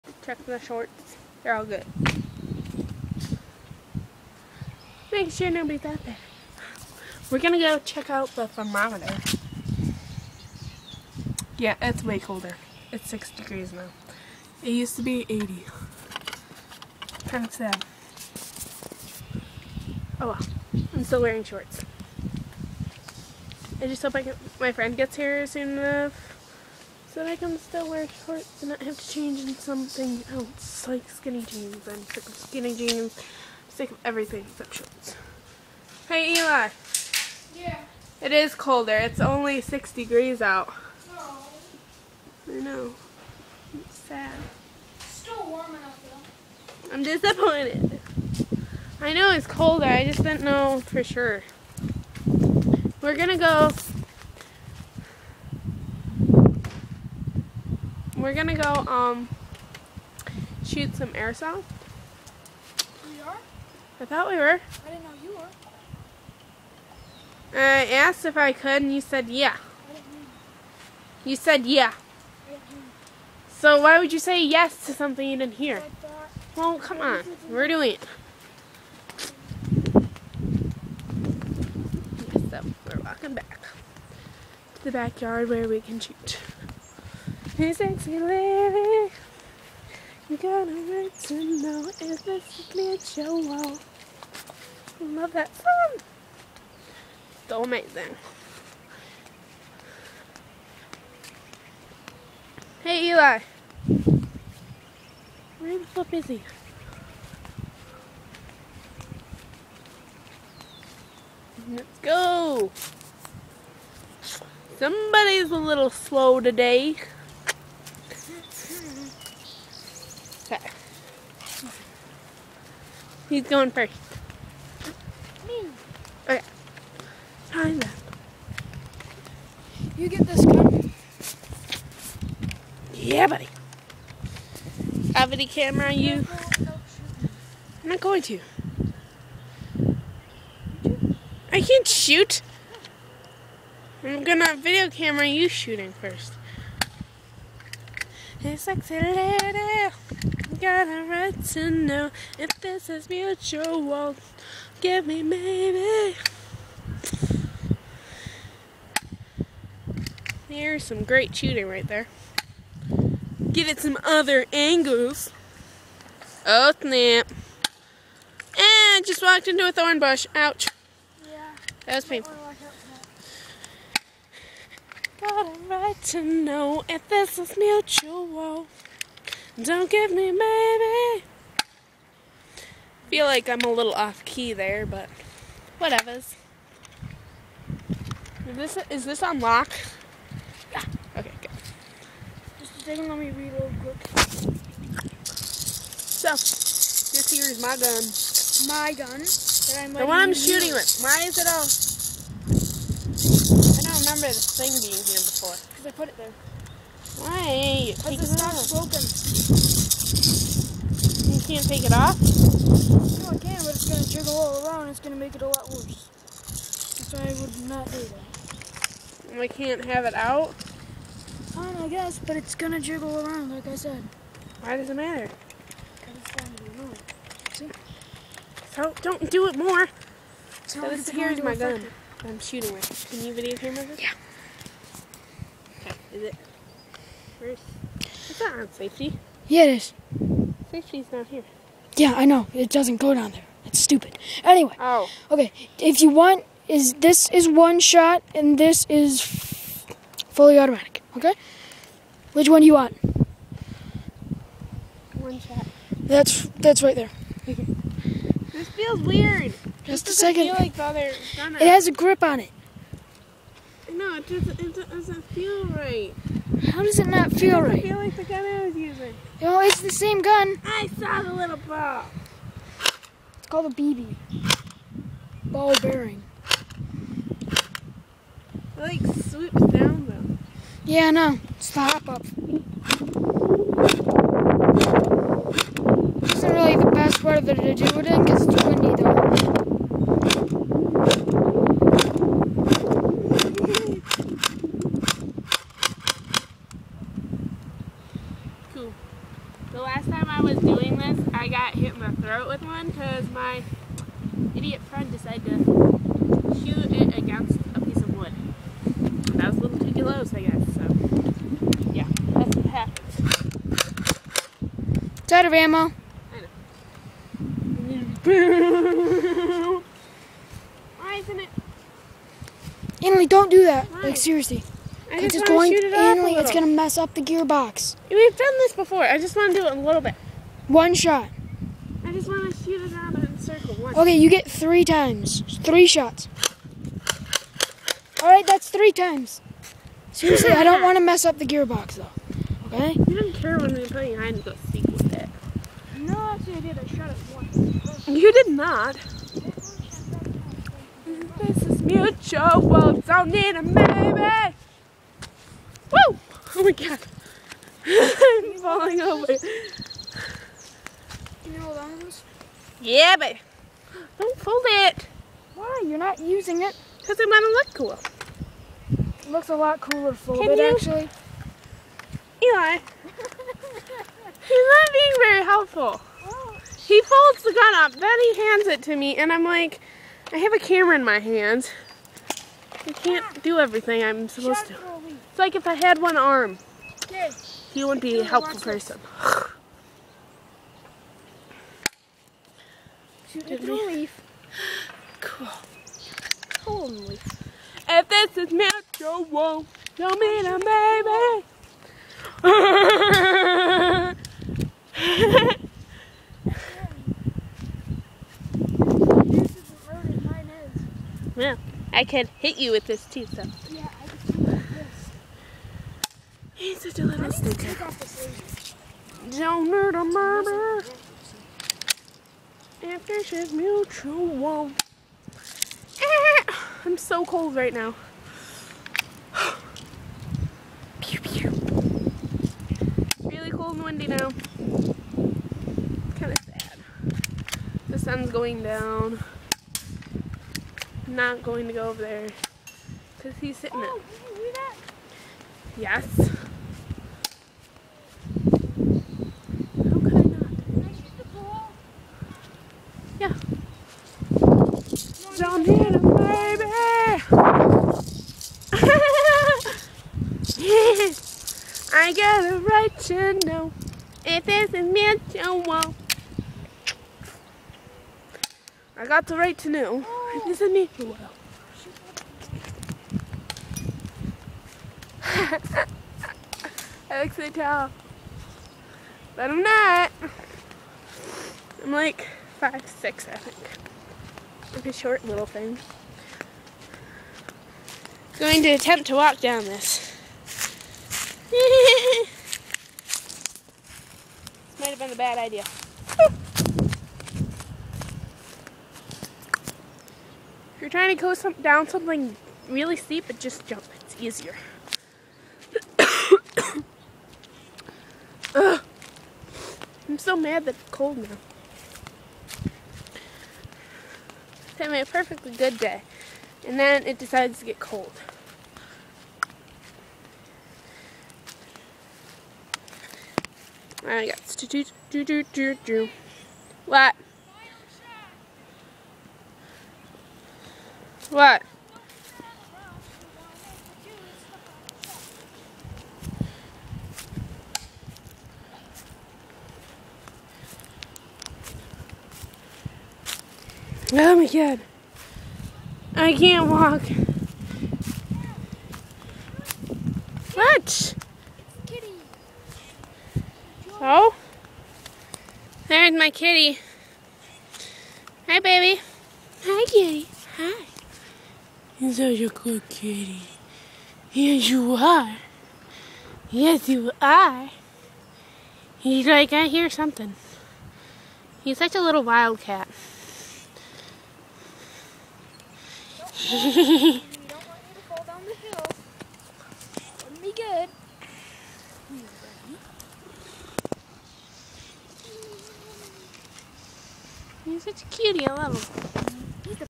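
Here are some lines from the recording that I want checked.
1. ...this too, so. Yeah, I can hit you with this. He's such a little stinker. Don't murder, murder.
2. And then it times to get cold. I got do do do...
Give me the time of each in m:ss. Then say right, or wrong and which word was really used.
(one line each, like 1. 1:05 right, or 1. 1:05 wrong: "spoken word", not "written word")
1. 6:52 right
2. 8:36 wrong: "decides", not "times".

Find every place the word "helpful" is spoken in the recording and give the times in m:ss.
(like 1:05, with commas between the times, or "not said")
6:15, 6:28.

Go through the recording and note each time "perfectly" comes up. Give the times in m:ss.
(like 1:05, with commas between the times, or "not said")
8:35.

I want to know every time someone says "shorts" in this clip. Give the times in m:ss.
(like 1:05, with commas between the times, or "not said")
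0:00, 0:21, 0:28, 0:34, 8:04.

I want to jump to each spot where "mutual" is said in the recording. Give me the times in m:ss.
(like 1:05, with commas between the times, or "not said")
2:33, 2:57, 5:51, 7:03, 7:44, 7:50.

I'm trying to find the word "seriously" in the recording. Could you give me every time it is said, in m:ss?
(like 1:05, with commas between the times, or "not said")
5:24, 5:40.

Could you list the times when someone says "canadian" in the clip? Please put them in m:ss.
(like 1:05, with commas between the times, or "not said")
not said.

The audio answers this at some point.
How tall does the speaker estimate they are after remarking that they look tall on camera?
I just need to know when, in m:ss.
8:02.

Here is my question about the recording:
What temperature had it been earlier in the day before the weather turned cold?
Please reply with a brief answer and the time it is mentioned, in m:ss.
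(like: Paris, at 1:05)
80, at 0:15.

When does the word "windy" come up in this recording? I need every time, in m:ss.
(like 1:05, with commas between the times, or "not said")
4:48, 7:13.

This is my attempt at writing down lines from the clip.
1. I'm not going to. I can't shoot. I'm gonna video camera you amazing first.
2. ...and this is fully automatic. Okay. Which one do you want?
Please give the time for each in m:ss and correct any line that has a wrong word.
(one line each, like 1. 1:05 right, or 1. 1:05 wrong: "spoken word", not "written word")
1. 2:17 wrong: "shooting", not "amazing"
2. 4:08 right.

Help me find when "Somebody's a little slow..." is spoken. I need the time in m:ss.
1:54.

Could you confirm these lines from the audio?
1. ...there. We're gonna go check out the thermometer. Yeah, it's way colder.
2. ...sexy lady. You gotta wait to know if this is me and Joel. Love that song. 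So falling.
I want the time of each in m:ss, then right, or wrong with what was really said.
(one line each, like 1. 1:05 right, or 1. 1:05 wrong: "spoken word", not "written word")
1. 0:06 right
2. 1:27 wrong: "amazing", not "falling".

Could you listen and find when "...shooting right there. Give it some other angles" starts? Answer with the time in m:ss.
2:41.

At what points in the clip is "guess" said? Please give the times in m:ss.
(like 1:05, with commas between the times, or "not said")
3:41, 5:10.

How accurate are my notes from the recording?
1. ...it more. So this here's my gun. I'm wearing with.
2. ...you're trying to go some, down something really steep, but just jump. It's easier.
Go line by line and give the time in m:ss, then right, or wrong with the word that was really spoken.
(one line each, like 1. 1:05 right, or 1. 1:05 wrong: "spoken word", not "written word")
1. 3:49 wrong: "shooting", not "wearing"
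2. 8:20 right.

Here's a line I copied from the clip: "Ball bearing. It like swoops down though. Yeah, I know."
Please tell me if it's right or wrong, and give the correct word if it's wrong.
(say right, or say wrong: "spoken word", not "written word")
right.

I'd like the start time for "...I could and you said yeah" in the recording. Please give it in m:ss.
1:08.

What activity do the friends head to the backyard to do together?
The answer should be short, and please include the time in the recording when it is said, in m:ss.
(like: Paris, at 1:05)
airsoft, at 1:01.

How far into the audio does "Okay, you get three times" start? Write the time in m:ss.
5:33.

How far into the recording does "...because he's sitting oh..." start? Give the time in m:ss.
7:23.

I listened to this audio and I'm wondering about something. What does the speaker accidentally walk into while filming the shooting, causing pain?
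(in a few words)
thorn bush.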